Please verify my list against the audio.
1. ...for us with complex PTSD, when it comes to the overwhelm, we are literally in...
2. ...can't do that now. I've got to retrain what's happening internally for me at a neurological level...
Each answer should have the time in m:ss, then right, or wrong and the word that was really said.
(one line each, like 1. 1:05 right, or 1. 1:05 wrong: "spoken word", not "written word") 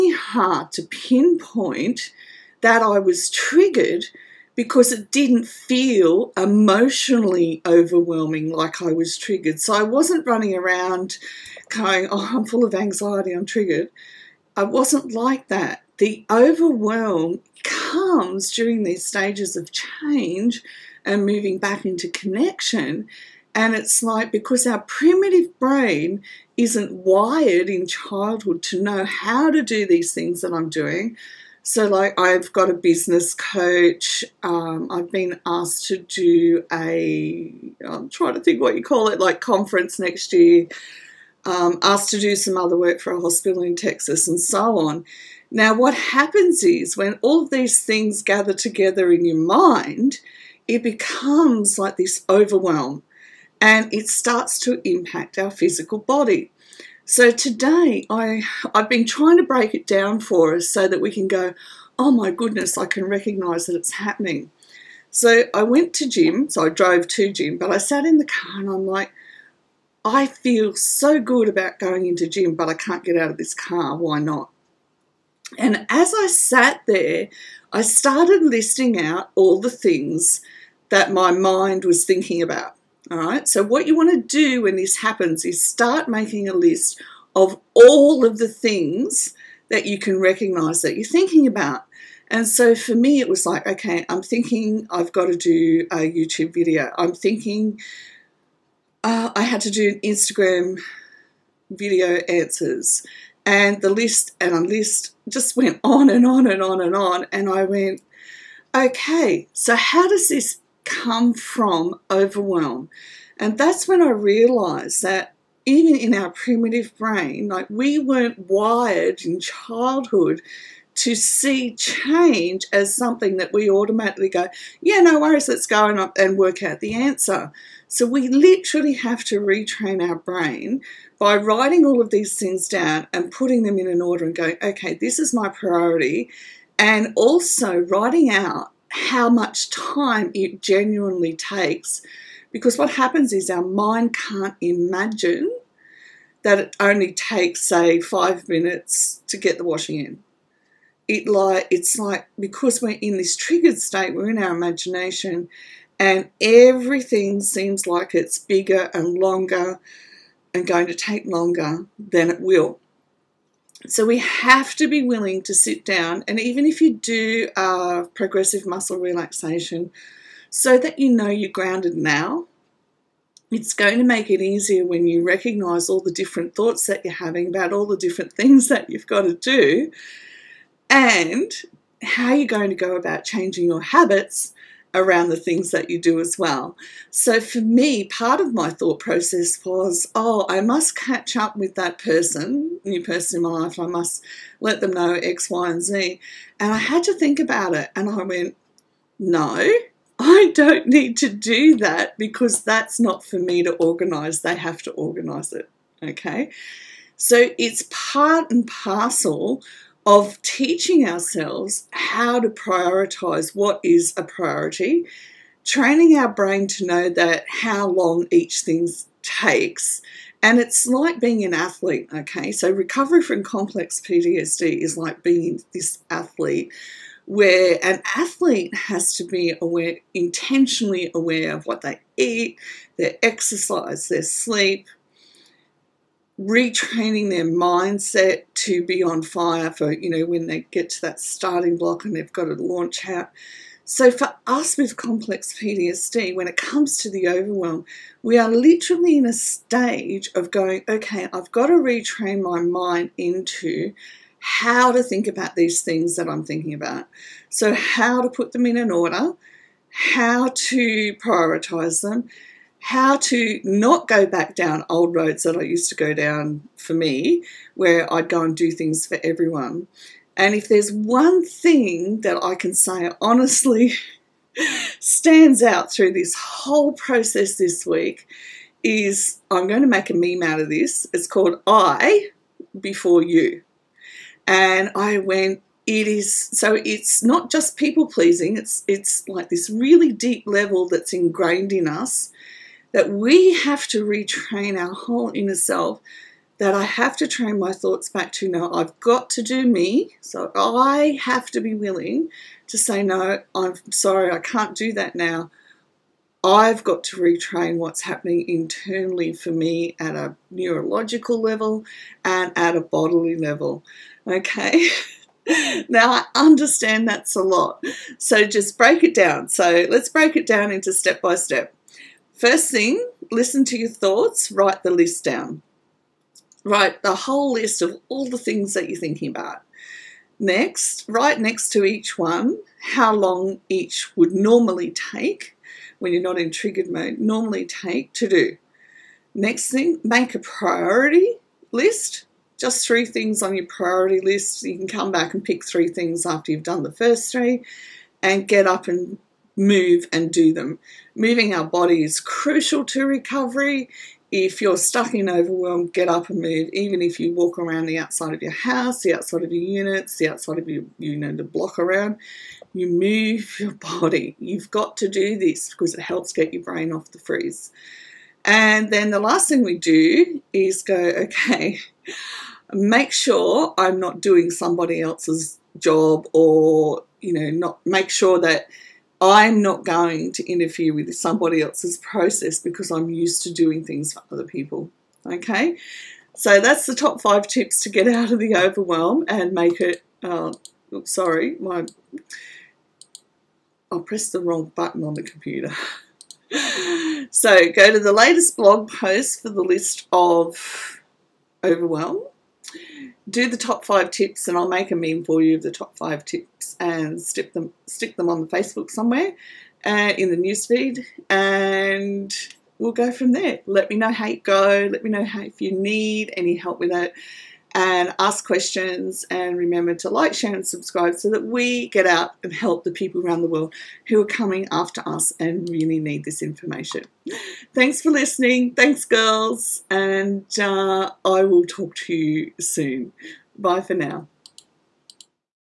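1. 4:04 right
2. 5:04 right.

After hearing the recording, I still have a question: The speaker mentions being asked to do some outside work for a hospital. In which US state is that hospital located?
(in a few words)
Texas.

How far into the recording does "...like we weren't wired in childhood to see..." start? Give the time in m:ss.
1:57.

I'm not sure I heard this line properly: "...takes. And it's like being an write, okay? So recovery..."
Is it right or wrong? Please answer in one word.
wrong.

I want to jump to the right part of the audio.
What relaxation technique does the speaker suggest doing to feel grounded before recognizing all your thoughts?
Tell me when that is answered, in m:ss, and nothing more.
2:48.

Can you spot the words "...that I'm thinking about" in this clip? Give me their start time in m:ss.
4:16.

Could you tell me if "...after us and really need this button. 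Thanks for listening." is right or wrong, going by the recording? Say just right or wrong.
wrong.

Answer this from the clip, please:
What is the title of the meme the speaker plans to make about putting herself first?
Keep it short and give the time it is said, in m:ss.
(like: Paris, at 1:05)
I Before You, at 4:41.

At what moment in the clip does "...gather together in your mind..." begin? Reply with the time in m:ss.
0:48.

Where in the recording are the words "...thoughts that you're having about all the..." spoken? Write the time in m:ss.
2:56.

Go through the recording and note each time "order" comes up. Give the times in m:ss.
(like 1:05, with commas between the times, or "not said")
2:14, 4:18.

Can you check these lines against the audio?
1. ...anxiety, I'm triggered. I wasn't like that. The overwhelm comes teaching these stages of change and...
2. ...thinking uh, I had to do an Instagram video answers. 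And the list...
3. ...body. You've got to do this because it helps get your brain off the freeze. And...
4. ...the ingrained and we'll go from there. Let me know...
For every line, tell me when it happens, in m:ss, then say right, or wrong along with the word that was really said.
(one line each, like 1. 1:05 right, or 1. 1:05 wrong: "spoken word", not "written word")
1. 0:12 wrong: "during", not "teaching"
2. 1:37 right
3. 6:03 right
4. 6:50 wrong: "newsfeed", not "ingrained".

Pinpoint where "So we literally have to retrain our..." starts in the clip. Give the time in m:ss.
2:07.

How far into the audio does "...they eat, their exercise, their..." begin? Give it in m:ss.
3:51.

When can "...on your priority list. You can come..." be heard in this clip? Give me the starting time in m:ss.
5:43.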